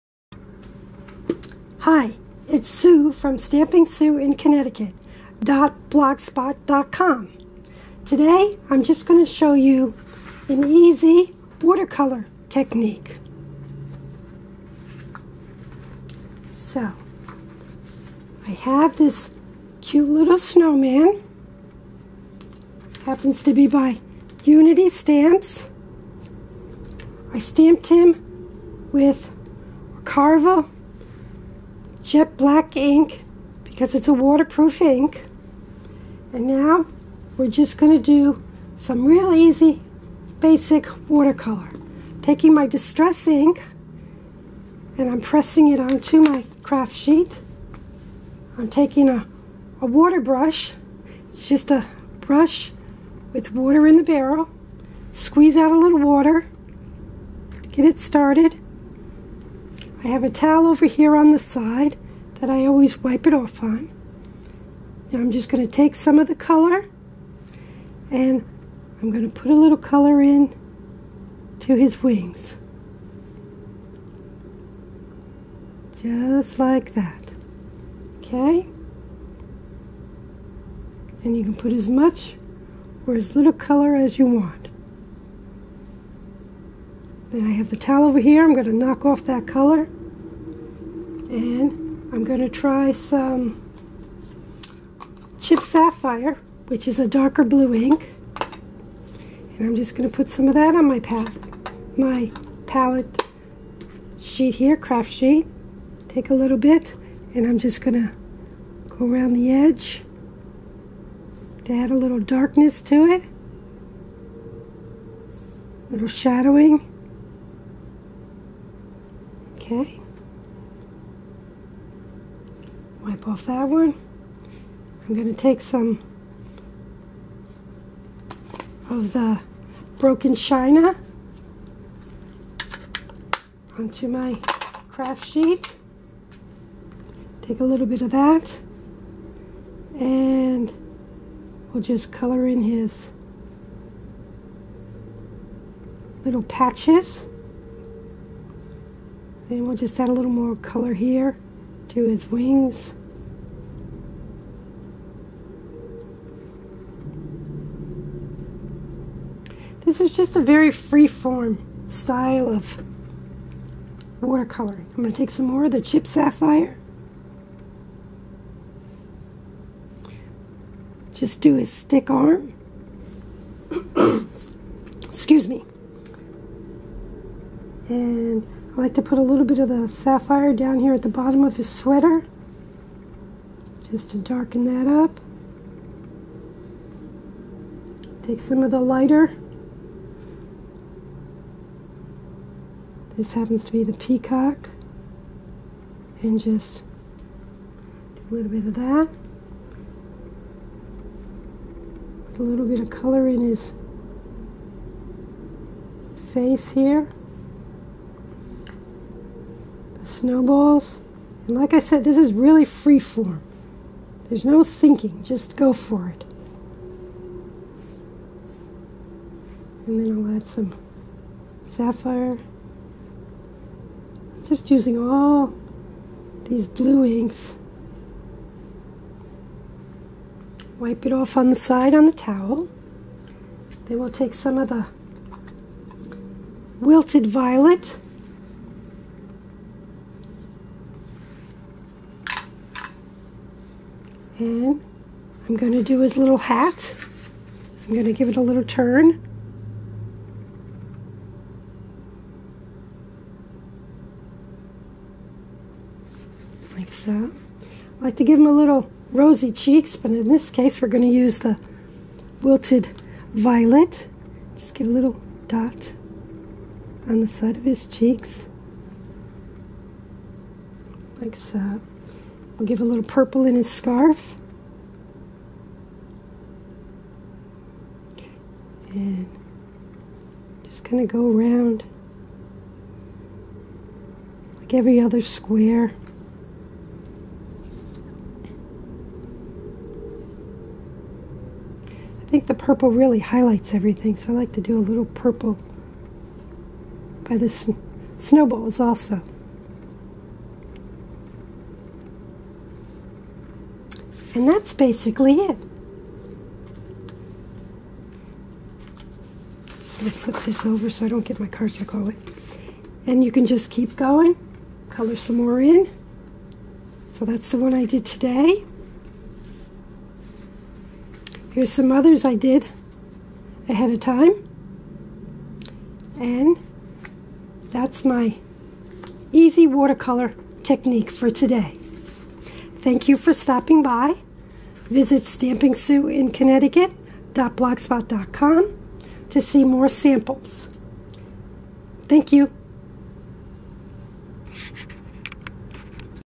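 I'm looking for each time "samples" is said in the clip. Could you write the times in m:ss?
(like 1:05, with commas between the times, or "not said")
5:39.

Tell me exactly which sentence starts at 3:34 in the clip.
There's no thinking, just go for it.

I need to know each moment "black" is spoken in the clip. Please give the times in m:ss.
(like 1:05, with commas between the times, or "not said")
0:32.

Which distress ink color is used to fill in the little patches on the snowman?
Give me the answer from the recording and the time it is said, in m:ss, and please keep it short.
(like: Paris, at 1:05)
broken china, at 2:09.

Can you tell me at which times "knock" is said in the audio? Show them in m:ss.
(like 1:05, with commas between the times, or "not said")
1:28.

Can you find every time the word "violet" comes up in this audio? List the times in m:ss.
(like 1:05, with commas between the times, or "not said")
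3:57, 4:23.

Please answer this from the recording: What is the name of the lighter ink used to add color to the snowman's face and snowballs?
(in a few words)
peacock.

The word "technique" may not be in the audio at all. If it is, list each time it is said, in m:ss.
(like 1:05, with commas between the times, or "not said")
0:12, 5:30.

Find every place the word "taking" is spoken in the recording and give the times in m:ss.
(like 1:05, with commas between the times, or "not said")
0:42, 0:48.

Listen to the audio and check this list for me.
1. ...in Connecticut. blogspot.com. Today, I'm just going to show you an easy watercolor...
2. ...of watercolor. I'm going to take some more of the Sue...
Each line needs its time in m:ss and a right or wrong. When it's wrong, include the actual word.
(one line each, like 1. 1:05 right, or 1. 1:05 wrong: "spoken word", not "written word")
1. 0:04 right
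2. 2:42 wrong: "Chip", not "Sue".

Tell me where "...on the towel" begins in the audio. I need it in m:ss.
3:51.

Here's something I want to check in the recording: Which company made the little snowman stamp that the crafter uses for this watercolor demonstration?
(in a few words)
Unity Stamps.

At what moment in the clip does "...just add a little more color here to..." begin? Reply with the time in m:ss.
2:29.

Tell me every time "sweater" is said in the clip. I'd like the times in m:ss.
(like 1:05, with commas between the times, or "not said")
3:01.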